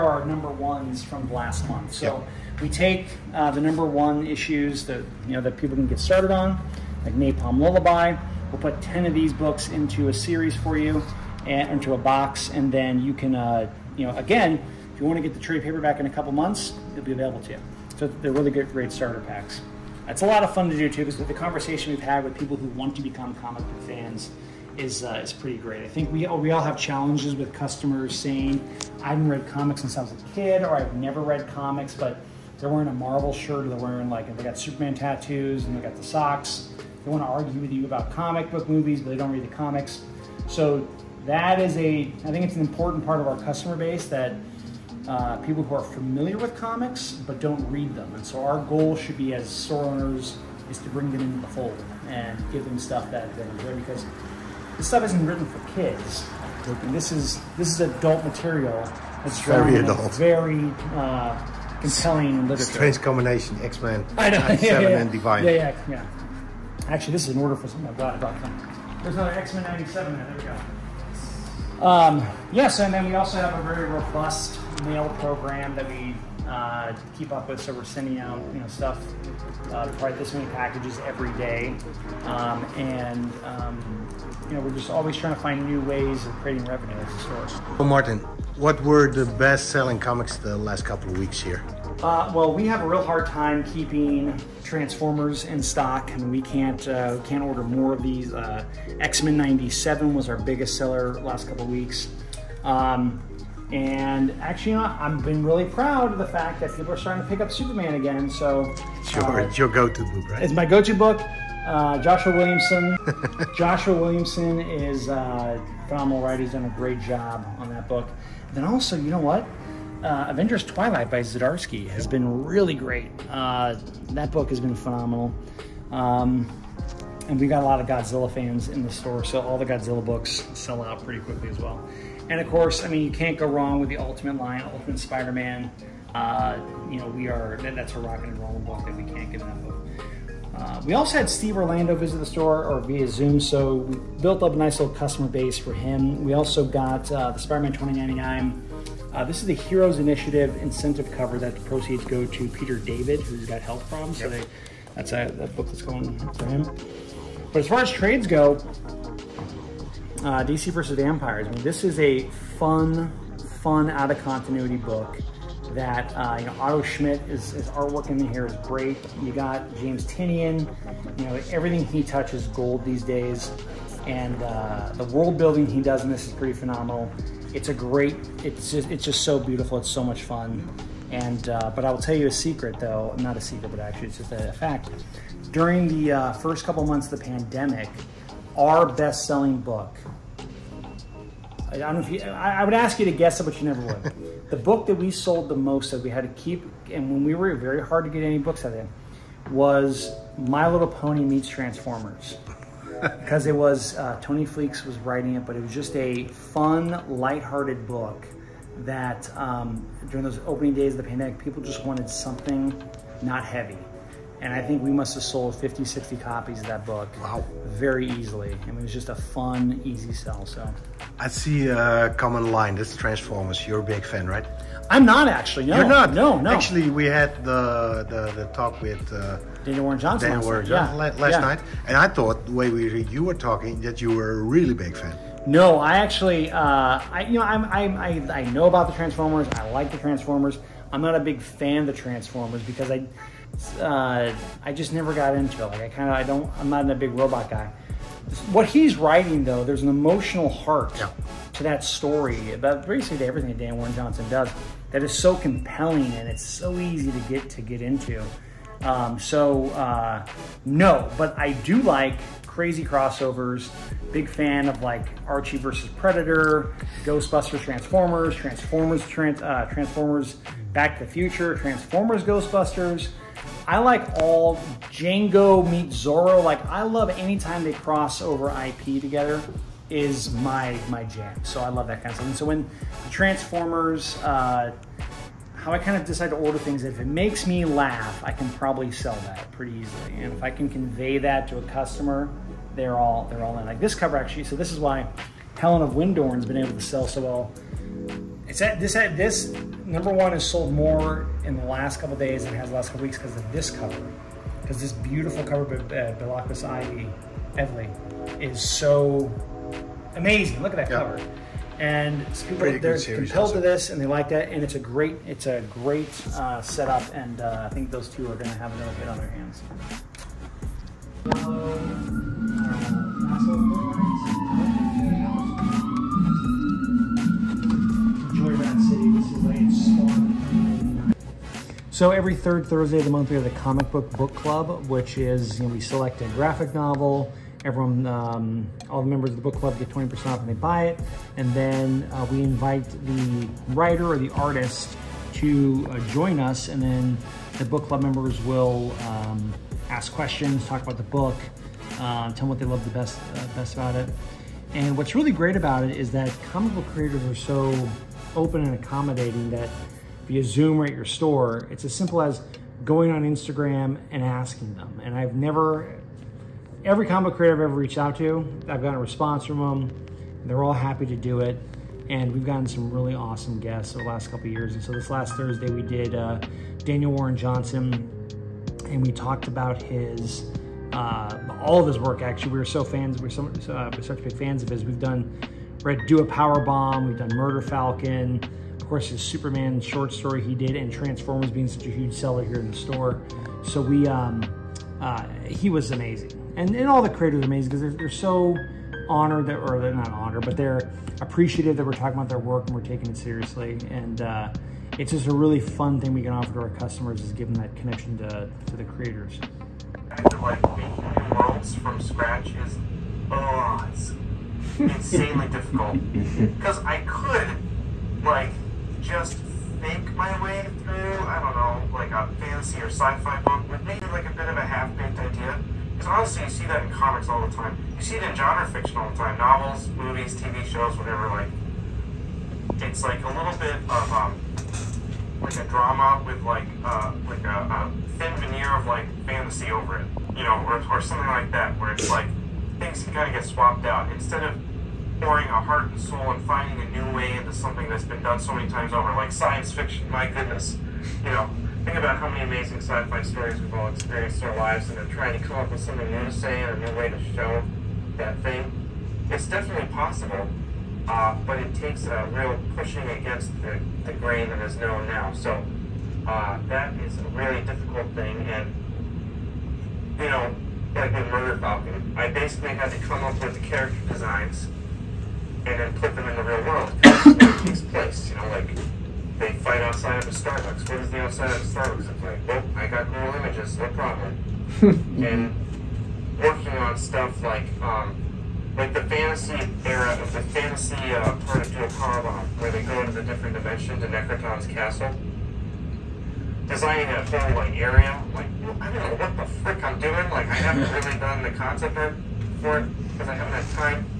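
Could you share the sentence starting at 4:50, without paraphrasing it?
And if I can convey that to a customer, they're all they're all in.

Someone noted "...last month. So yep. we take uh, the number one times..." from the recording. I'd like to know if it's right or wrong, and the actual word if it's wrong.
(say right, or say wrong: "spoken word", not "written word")
wrong: "issues", not "times".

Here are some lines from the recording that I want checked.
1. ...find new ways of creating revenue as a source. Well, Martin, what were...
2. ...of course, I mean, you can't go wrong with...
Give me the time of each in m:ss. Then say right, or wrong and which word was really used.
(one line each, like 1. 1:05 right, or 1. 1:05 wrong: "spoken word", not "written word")
1. 1:25 right
2. 2:12 right.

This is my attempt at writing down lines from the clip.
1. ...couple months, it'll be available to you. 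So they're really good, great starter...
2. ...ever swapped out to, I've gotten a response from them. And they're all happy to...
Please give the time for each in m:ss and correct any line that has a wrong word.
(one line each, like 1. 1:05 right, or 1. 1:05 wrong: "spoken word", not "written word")
1. 0:16 right
2. 6:07 wrong: "reached", not "swapped".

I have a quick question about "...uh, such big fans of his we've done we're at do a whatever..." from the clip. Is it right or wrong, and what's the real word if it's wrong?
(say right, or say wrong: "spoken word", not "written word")
wrong: "power", not "whatever".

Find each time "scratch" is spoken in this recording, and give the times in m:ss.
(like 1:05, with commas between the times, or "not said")
6:52.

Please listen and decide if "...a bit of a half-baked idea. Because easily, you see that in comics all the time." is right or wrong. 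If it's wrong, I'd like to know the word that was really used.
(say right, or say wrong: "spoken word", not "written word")
wrong: "honestly", not "easily".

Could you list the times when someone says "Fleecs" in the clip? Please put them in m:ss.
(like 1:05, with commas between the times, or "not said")
3:24.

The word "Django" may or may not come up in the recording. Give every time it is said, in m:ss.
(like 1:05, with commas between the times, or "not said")
4:34.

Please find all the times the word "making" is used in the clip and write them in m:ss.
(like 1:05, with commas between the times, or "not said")
6:50.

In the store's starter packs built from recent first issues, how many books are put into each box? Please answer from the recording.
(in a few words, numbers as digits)
10.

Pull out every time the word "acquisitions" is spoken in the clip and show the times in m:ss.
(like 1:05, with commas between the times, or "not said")
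not said.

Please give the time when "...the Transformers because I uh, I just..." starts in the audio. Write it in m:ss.
4:01.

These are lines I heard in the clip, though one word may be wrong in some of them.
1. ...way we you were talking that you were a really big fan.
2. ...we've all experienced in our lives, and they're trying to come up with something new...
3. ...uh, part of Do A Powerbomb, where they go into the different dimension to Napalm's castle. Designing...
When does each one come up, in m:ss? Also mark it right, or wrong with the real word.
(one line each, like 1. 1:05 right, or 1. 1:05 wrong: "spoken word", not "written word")
1. 3:52 right
2. 7:33 right
3. 8:10 wrong: "Necroton", not "Napalm".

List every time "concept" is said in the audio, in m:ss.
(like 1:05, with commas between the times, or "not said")
8:21.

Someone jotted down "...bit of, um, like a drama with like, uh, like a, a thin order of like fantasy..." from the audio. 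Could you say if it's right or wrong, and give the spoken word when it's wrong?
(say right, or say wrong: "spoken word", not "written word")
wrong: "veneer", not "order".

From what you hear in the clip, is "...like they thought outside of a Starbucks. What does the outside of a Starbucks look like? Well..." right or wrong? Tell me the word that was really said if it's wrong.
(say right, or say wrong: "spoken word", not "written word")
wrong: "fight", not "thought".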